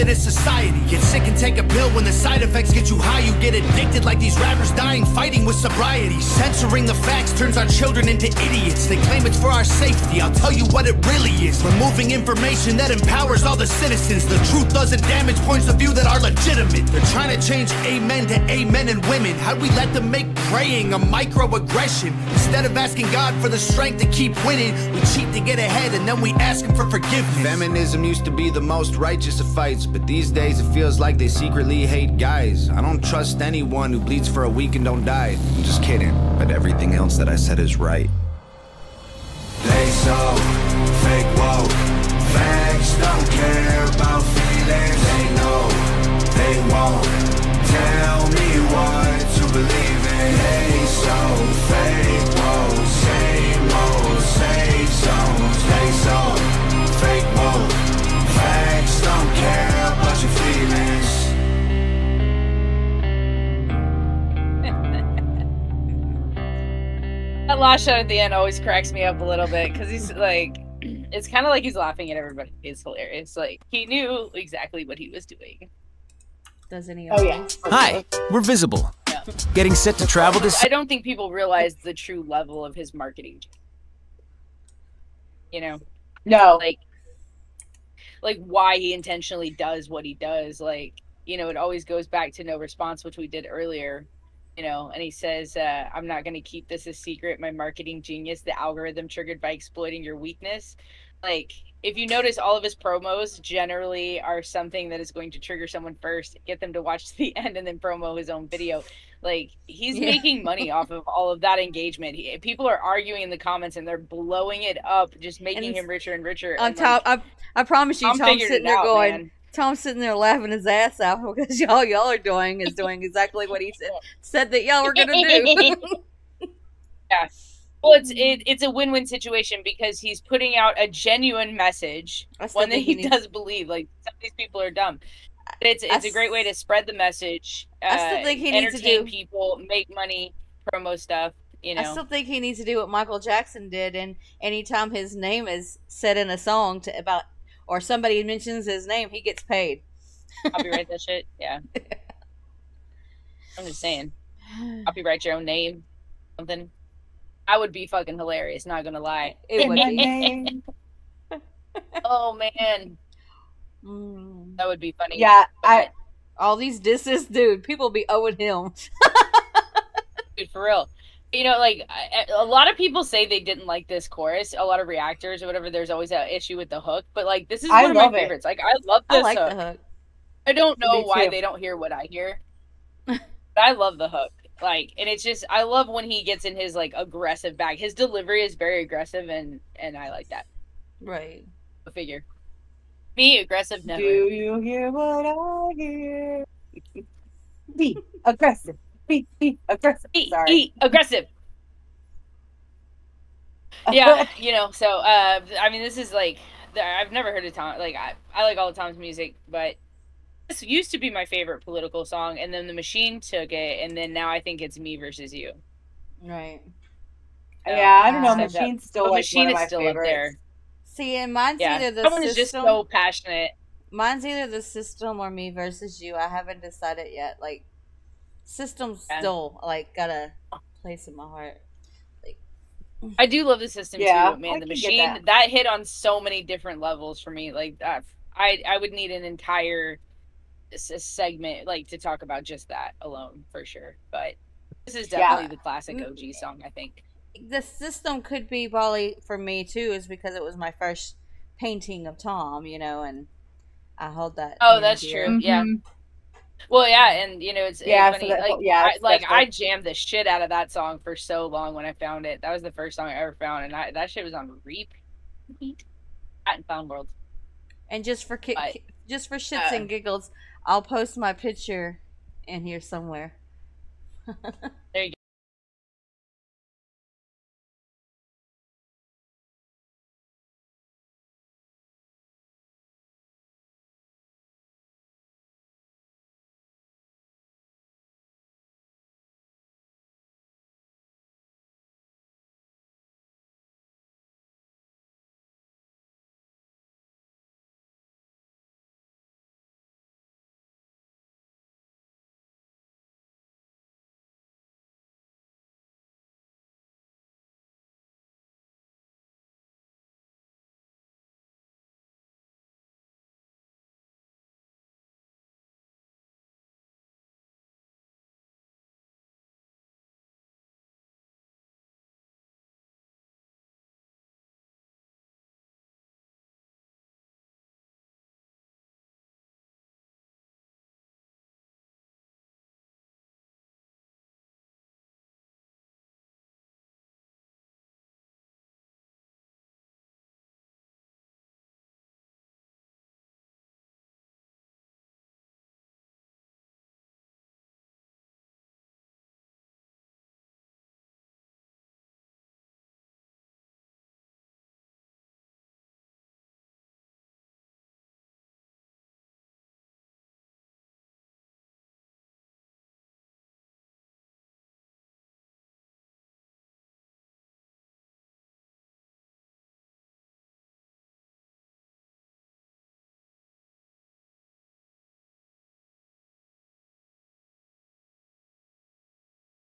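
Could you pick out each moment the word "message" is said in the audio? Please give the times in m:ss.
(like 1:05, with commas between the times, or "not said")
2:11, 2:16.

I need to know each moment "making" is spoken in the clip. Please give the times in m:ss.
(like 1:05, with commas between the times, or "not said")
1:50, 1:55.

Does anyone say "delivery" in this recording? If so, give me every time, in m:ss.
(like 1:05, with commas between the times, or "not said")
3:07.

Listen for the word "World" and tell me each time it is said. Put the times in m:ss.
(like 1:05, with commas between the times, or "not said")
4:26.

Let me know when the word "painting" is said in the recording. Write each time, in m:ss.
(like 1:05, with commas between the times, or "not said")
4:11.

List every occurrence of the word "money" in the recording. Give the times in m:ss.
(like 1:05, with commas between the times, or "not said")
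1:50, 2:19.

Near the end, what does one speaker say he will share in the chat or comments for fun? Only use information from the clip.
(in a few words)
My picture.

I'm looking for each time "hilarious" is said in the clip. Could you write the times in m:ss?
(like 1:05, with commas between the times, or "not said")
1:12, 2:38.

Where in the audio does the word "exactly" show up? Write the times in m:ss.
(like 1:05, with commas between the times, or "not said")
1:14, 2:03.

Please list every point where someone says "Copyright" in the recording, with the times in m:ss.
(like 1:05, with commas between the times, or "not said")
2:30, 2:34.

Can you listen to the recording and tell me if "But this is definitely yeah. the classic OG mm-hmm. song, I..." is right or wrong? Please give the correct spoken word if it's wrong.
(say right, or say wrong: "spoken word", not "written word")
right.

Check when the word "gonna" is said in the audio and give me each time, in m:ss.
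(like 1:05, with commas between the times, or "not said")
2:04, 2:38.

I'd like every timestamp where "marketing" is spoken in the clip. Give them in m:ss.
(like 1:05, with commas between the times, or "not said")
1:22, 1:37.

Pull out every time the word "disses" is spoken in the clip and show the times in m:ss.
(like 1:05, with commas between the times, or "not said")
2:46.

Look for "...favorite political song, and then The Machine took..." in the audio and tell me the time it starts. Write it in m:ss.
3:31.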